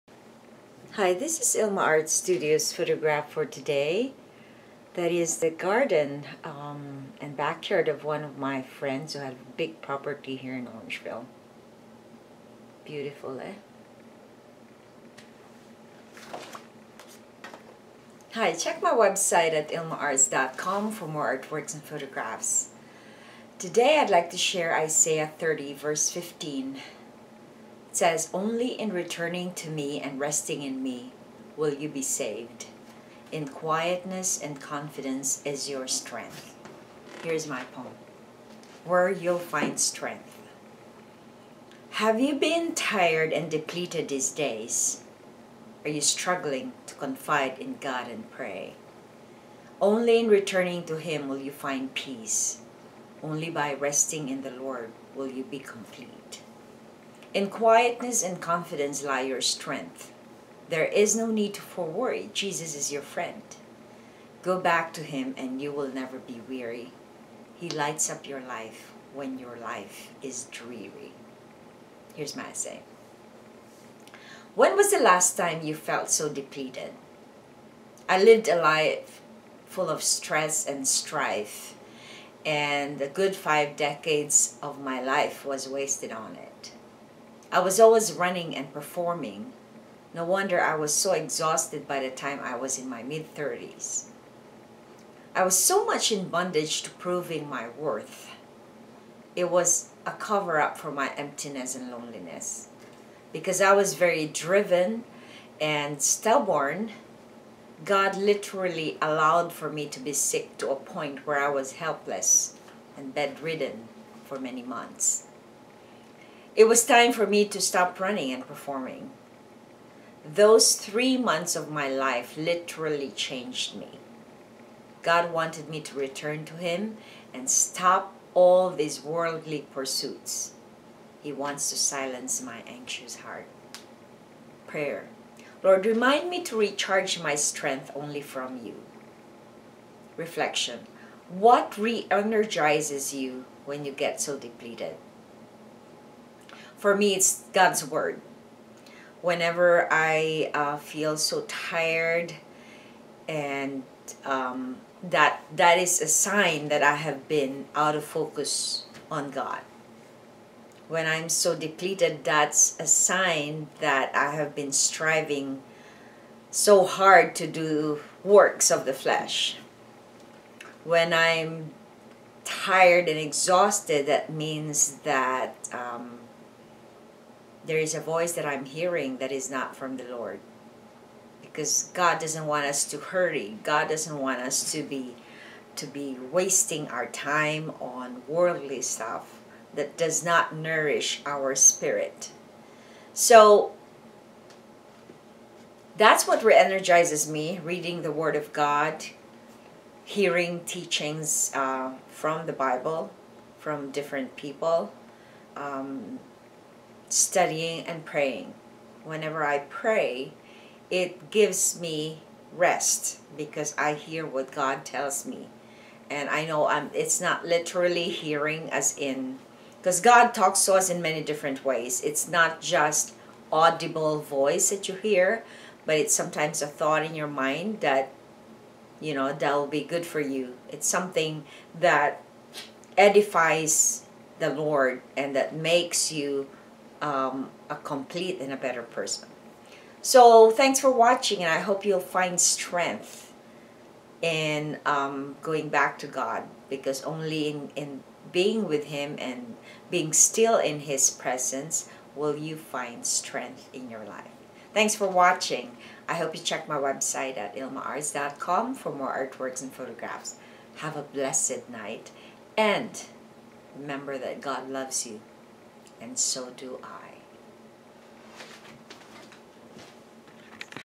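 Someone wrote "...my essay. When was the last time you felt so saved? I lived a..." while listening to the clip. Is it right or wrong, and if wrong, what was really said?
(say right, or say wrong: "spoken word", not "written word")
wrong: "depleted", not "saved".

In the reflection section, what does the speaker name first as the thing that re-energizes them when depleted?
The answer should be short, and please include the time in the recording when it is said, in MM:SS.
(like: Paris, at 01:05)
God's Word, at 02:27.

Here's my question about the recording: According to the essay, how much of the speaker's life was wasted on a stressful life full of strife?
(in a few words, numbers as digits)
five decades.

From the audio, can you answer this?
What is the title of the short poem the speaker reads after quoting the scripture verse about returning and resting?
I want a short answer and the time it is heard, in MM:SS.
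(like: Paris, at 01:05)
Where You'll Find Strength, at 00:38.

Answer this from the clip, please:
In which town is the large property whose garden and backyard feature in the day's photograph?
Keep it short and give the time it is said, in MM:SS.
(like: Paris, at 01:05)
Orangeville, at 00:10.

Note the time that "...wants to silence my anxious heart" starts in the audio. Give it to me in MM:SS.
02:11.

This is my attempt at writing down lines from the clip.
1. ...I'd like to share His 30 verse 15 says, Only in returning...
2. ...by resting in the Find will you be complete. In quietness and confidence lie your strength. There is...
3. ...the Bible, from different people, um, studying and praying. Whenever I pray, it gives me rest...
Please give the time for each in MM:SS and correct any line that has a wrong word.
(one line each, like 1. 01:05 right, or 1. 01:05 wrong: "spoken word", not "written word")
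1. 00:23 wrong: "Isaiah", not "His"
2. 00:53 wrong: "Lord", not "Find"
3. 03:22 right.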